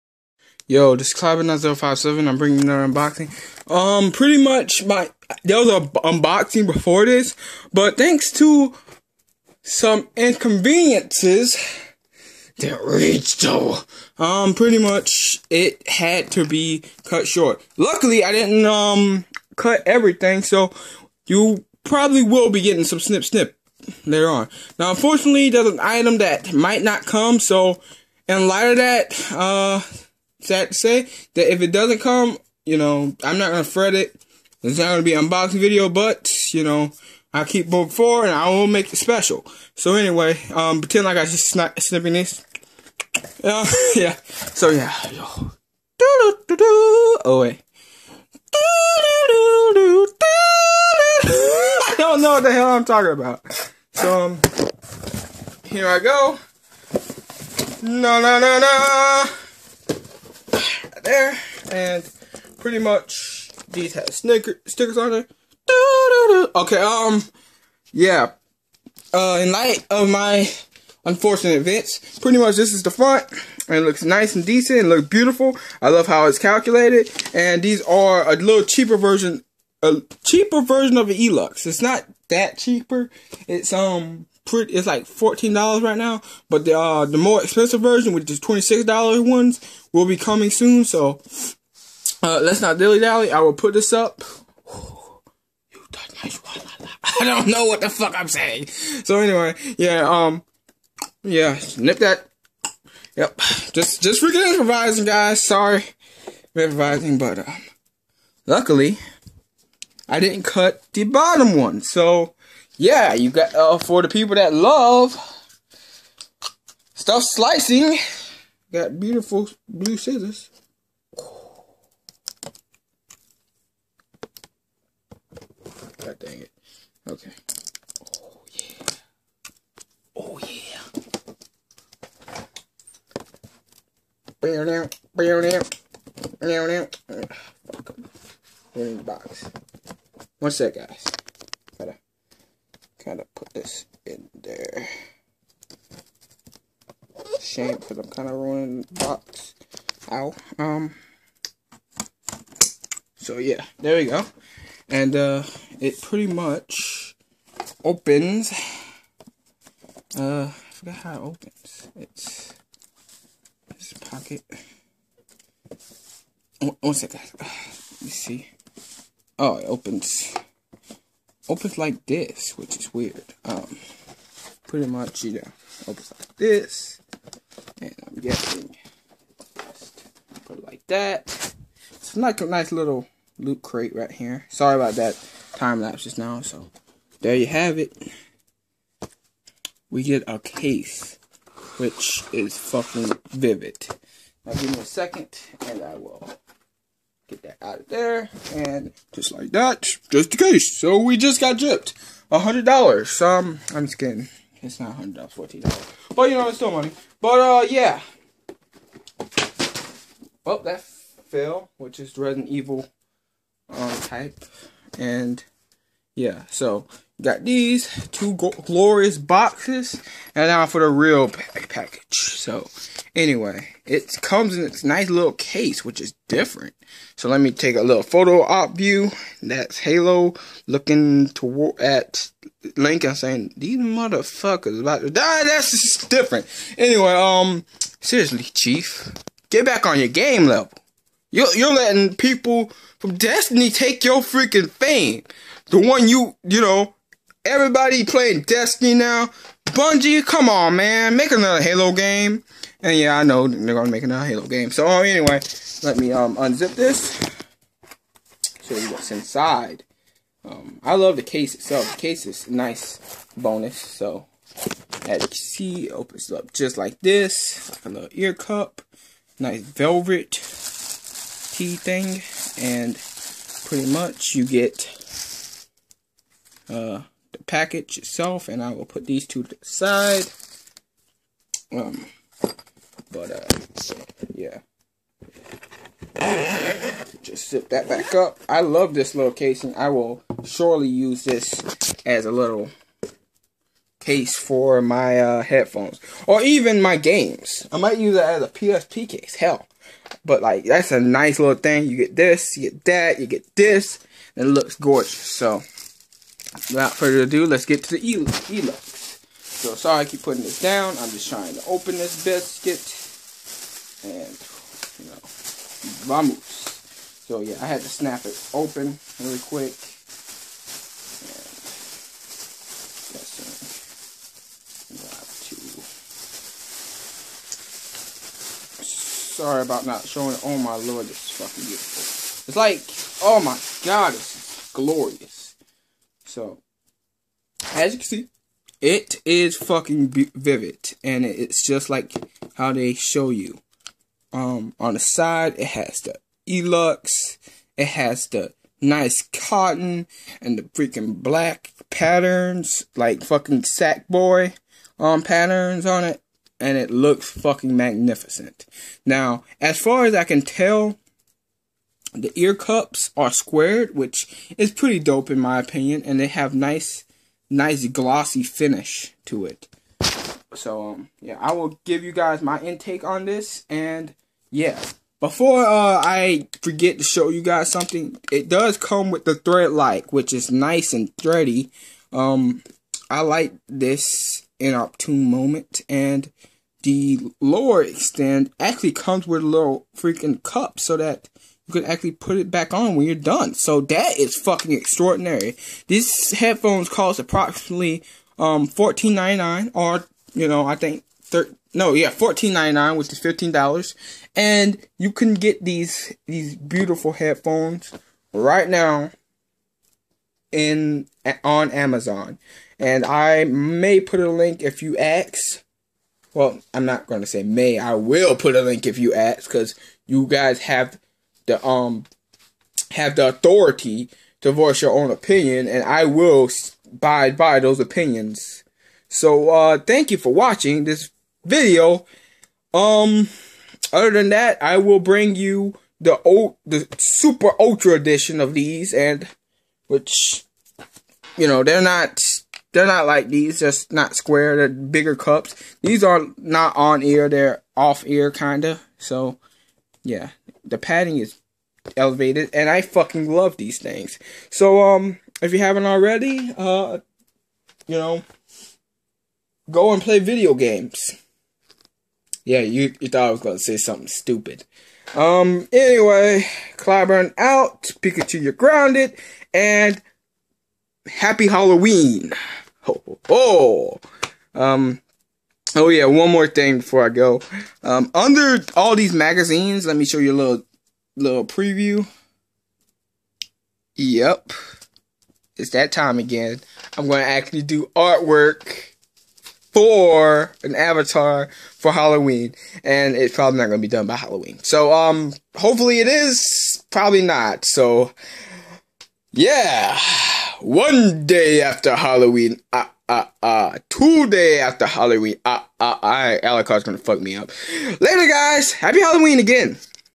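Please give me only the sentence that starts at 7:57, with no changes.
Um, under all these magazines, let me show you a little little preview.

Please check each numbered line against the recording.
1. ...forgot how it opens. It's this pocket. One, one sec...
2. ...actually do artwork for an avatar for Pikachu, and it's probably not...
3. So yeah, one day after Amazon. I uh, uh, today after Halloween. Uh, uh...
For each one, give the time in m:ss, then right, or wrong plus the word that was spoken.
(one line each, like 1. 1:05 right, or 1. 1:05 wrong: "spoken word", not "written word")
1. 2:40 right
2. 8:07 wrong: "Halloween", not "Pikachu"
3. 8:17 wrong: "Halloween", not "Amazon".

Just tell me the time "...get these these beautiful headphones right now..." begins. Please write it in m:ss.
6:45.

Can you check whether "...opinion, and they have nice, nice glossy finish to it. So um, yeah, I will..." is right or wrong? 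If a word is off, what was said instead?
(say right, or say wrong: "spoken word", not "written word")
right.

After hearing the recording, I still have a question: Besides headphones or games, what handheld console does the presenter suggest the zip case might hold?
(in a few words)
PSP.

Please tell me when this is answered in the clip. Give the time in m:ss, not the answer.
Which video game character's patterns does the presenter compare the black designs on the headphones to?
5:53.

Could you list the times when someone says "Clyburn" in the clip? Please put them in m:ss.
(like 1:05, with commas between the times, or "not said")
0:01, 7:46.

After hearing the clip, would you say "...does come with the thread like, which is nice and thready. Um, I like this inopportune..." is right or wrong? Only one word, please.
right.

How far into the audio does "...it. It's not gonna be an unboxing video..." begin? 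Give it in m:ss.
0:33.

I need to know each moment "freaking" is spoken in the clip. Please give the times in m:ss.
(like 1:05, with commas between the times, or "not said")
1:44, 4:04, 5:50, 6:29.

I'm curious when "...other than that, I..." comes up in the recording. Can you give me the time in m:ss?
7:13.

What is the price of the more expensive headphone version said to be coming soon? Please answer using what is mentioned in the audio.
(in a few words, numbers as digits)
$26.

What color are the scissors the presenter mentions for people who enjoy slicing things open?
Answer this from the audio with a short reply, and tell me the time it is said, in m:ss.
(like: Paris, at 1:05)
Blue, at 1:59.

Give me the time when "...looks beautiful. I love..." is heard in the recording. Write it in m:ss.
1:14.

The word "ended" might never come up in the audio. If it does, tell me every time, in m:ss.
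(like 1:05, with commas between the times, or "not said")
not said.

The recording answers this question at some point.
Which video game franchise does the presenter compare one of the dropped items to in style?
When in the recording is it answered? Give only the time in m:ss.
3:32.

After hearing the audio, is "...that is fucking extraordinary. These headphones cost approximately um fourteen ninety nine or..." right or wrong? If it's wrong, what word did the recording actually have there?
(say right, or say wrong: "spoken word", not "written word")
right.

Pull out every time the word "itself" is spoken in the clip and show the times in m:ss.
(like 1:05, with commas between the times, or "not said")
4:21, 4:37.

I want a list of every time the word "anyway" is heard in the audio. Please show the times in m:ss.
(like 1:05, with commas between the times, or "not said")
0:39, 1:39, 3:43, 3:56, 4:15, 7:45.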